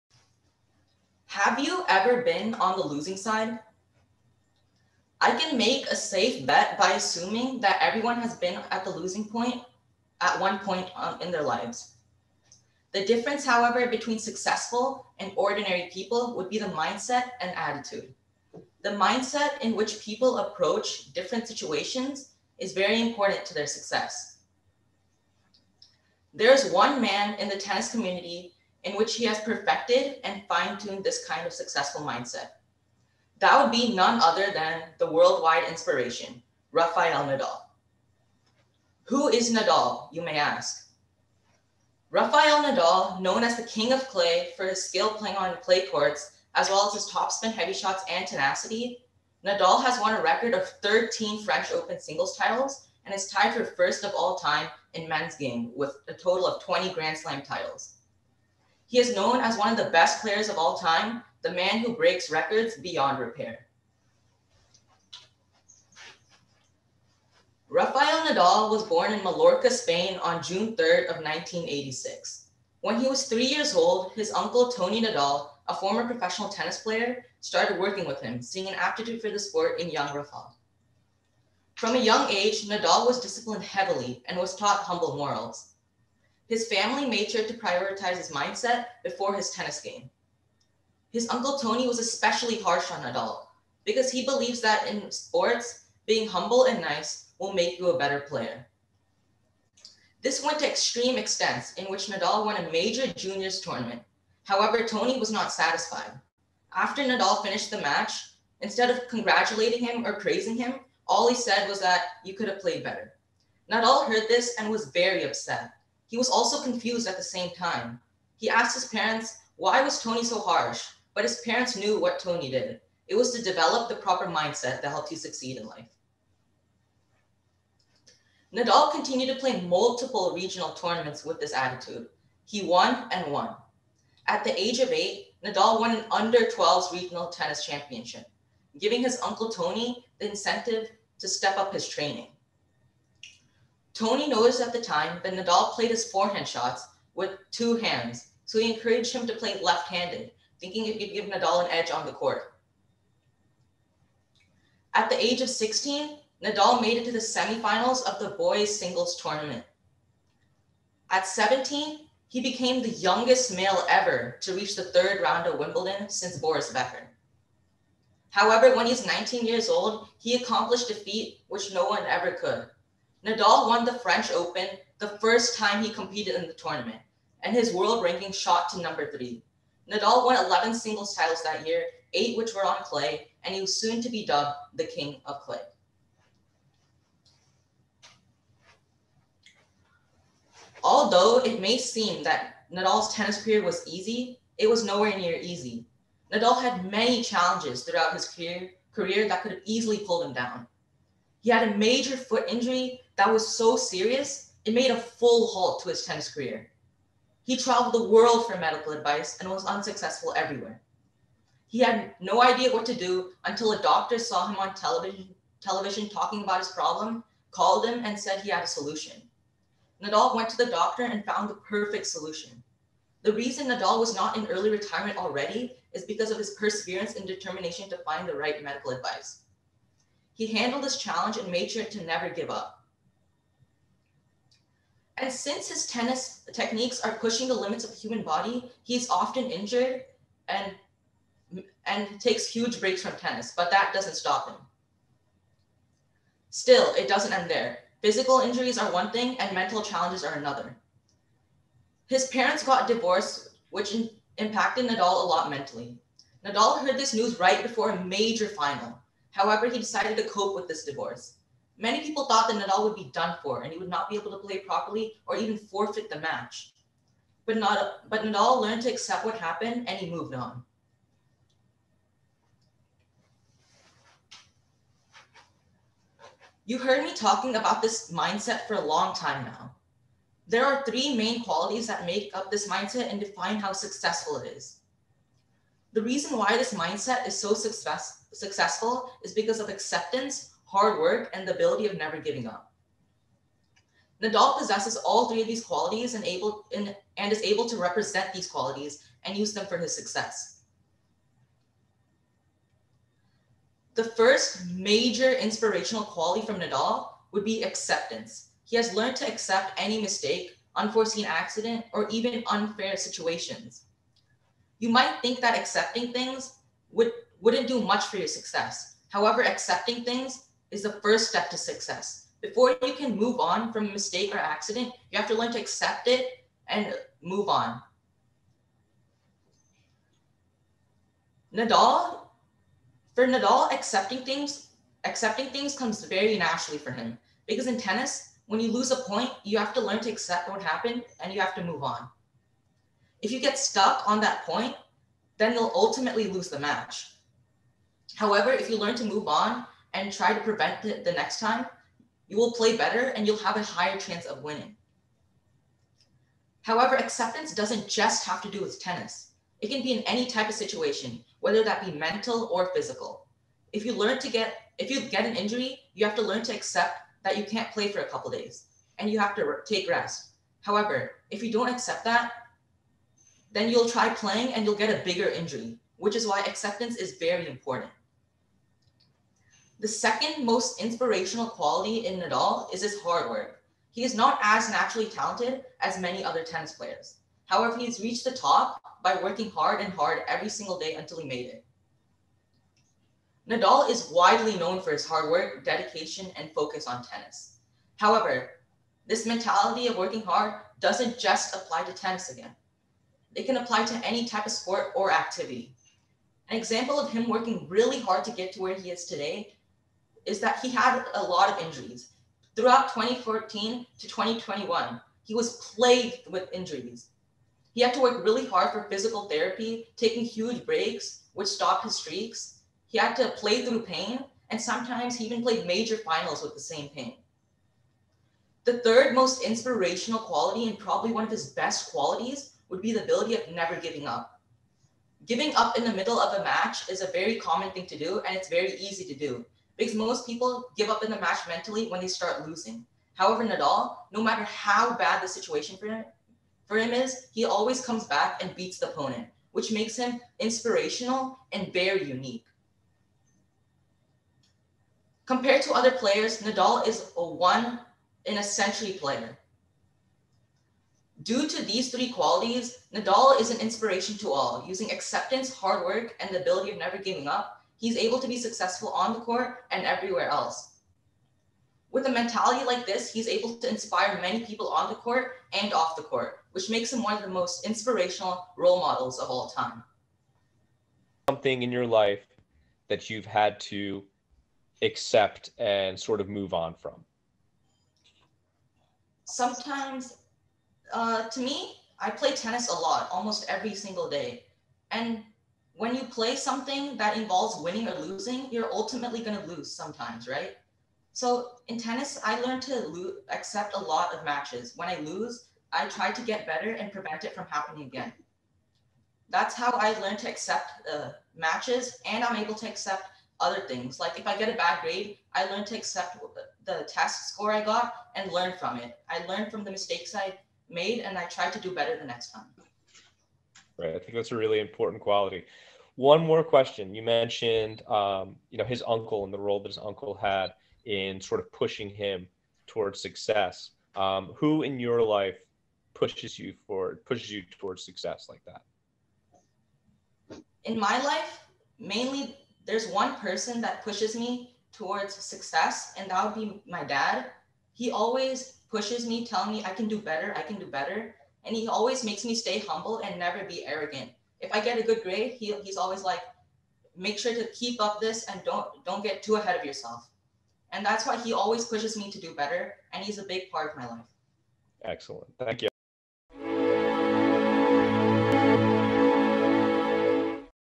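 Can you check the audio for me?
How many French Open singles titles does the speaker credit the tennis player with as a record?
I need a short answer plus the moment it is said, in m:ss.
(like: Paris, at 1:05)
13, at 0:50.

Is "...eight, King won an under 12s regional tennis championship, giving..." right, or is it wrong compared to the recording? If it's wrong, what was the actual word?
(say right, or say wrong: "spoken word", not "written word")
wrong: "Nadal", not "King".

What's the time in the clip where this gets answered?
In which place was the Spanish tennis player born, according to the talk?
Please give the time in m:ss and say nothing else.
1:09.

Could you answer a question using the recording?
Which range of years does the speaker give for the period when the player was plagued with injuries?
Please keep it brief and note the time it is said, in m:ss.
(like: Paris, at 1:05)
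2014 to 2021, at 6:52.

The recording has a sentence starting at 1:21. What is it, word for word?
From a young age, Nadal was disciplined heavily and was taught humble morals.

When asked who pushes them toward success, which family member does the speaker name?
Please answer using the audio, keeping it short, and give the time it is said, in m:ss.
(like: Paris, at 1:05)
Dad, at 9:06.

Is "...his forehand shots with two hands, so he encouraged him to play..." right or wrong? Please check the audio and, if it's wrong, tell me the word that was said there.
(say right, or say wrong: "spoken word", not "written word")
right.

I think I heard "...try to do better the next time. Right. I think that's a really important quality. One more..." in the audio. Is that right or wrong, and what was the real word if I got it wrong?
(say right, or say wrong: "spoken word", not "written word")
right.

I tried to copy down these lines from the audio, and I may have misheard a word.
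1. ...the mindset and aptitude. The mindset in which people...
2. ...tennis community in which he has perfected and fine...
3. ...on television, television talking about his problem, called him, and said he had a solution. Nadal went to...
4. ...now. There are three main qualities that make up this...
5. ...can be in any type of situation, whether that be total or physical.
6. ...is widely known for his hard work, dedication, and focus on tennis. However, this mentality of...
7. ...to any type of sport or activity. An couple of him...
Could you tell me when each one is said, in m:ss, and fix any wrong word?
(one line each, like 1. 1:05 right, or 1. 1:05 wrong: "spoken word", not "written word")
1. 0:16 wrong: "attitude", not "aptitude"
2. 0:27 right
3. 3:34 right
4. 4:39 right
5. 5:59 wrong: "mental", not "total"
6. 6:33 right
7. 6:43 wrong: "example", not "couple".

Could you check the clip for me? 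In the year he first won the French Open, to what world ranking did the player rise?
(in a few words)
3.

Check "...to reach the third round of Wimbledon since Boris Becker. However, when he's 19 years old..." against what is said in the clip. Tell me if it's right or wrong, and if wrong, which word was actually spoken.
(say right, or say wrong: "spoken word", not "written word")
right.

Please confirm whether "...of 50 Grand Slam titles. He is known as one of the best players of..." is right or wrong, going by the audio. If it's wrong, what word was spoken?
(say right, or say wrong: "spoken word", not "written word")
wrong: "20", not "50".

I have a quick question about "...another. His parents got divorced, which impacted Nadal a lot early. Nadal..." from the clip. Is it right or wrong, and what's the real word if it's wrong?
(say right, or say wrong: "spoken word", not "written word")
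wrong: "mentally", not "early".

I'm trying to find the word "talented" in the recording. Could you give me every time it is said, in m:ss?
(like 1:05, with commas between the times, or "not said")
6:25.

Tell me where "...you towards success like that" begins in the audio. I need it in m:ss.
8:57.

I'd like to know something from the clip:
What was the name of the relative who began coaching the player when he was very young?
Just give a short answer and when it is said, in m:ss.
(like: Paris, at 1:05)
Tony Nadal, at 1:14.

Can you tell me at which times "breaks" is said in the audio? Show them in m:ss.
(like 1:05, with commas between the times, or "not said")
1:01, 4:02, 7:00.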